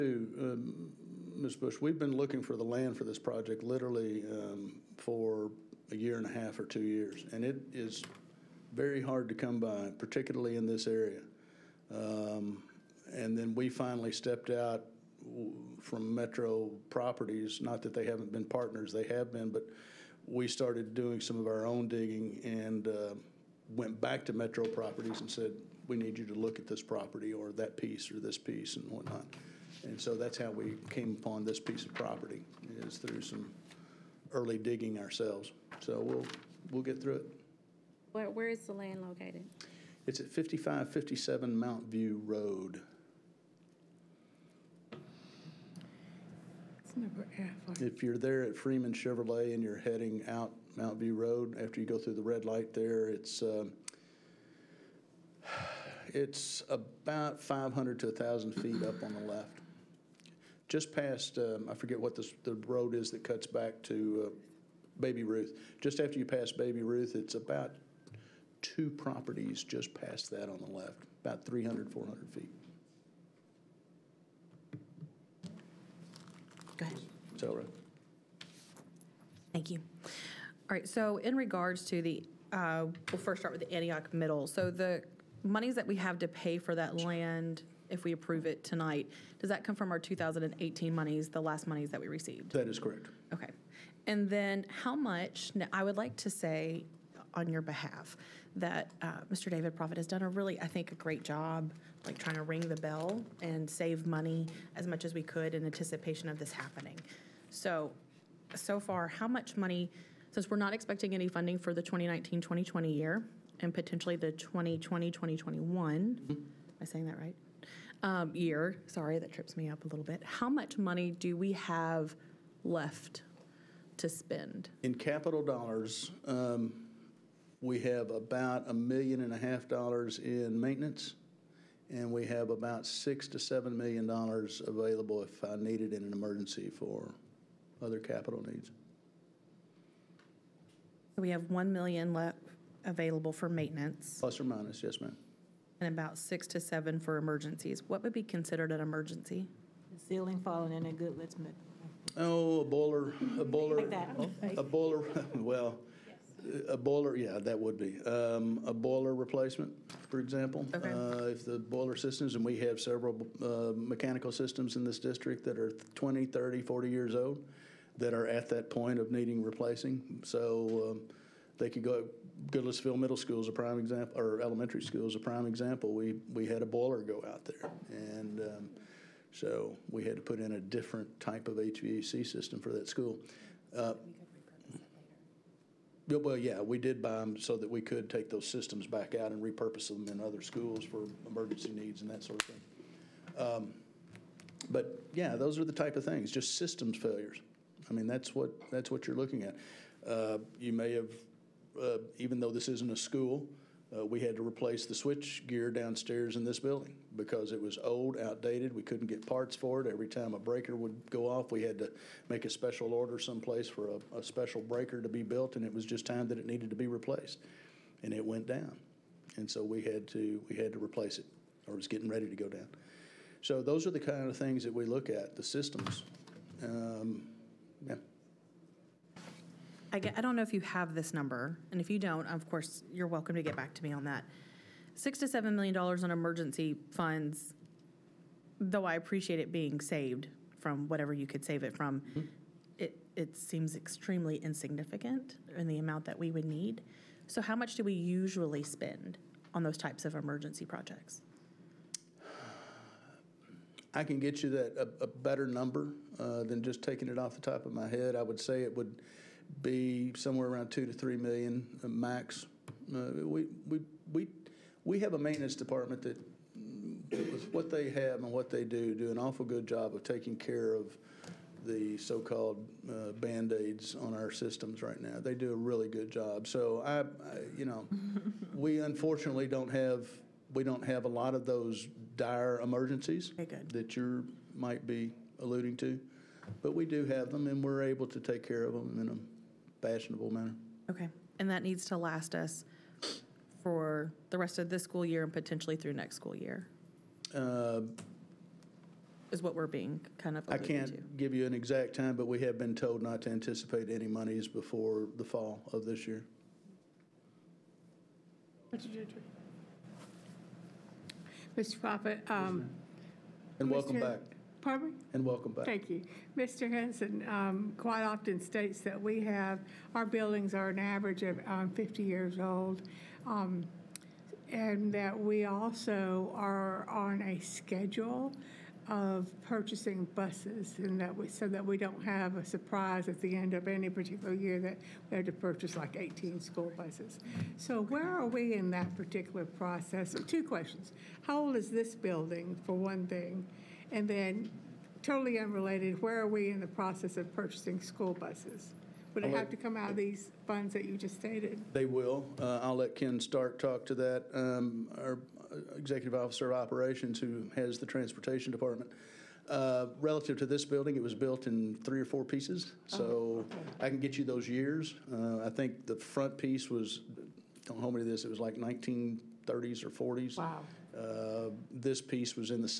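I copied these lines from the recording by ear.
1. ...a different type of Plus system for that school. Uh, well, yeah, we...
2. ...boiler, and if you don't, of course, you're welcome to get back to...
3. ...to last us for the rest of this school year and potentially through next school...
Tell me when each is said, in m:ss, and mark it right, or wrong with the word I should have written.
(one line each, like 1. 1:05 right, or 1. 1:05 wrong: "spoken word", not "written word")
1. 3:00 wrong: "HVAC", not "Plus"
2. 3:51 wrong: "number", not "boiler"
3. 4:51 right.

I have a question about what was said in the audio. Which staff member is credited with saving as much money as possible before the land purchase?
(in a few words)
David Proffitt.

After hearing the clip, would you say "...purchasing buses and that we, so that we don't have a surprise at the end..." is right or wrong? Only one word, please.
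right.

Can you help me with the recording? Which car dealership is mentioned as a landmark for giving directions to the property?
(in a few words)
Freeman Chevrolet.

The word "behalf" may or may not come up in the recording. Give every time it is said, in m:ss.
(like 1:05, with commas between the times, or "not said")
1:37.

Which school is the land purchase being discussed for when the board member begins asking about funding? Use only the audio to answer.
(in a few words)
Antioch Middle.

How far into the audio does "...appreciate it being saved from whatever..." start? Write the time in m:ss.
3:58.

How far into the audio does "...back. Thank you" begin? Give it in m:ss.
5:15.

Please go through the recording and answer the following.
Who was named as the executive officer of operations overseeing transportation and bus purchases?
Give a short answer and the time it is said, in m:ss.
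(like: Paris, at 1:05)
Ken Stark, at 5:52.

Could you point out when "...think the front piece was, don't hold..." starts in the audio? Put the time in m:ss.
6:05.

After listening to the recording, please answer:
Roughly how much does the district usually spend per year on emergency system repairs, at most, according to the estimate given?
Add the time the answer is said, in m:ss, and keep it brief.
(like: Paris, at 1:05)
2 to 3 million, at 4:20.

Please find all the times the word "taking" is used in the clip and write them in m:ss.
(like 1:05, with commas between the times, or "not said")
4:16, 4:30.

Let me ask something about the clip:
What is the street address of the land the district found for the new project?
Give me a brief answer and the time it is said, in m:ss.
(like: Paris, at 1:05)
5557 Mount View Road, at 0:40.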